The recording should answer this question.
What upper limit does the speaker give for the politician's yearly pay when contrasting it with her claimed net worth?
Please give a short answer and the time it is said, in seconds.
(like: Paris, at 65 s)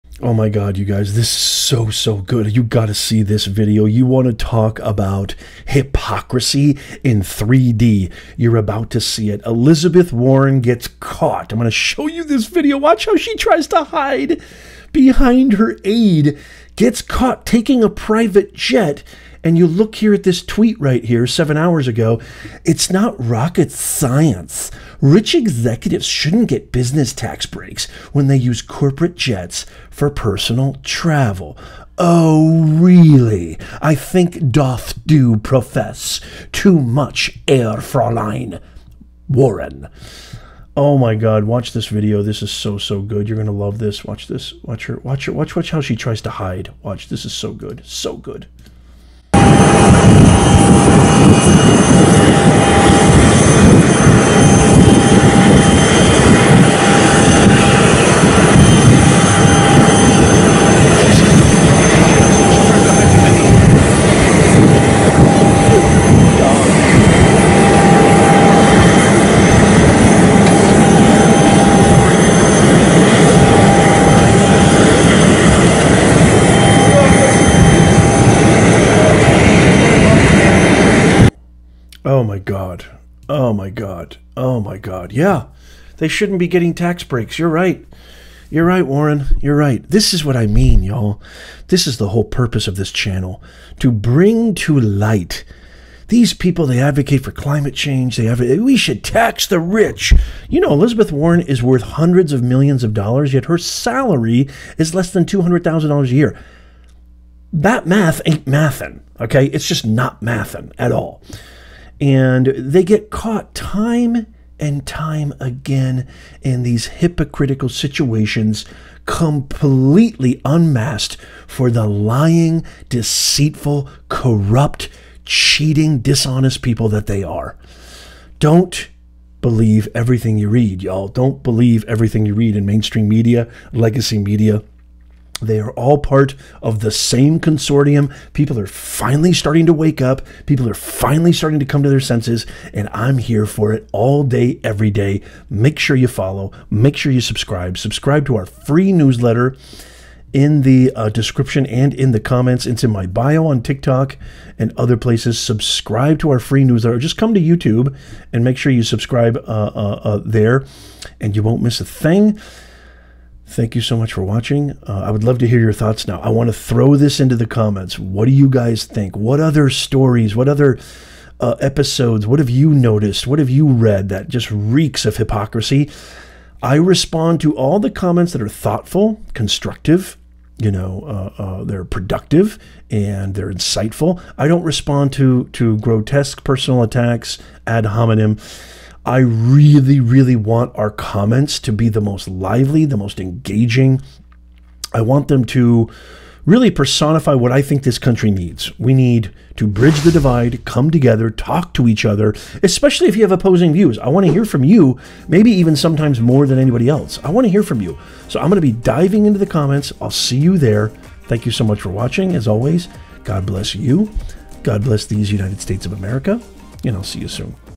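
$200,000, at 105 s.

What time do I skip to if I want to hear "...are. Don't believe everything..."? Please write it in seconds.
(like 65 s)
127 s.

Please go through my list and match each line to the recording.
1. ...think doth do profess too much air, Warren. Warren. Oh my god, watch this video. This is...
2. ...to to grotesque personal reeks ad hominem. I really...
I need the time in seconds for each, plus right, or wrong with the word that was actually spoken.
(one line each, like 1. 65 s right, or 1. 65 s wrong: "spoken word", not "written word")
1. 33 s wrong: "Fräulein", not "Warren"
2. 185 s wrong: "attacks", not "reeks".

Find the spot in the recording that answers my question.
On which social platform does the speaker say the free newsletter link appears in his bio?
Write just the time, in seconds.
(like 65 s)
153 s.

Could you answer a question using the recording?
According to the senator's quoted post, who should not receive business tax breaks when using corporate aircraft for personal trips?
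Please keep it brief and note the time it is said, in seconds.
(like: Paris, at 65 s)
Rich executives, at 25 s.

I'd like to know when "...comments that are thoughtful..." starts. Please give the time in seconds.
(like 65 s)
177 s.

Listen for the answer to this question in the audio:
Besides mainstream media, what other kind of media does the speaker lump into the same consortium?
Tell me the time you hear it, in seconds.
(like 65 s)
133 s.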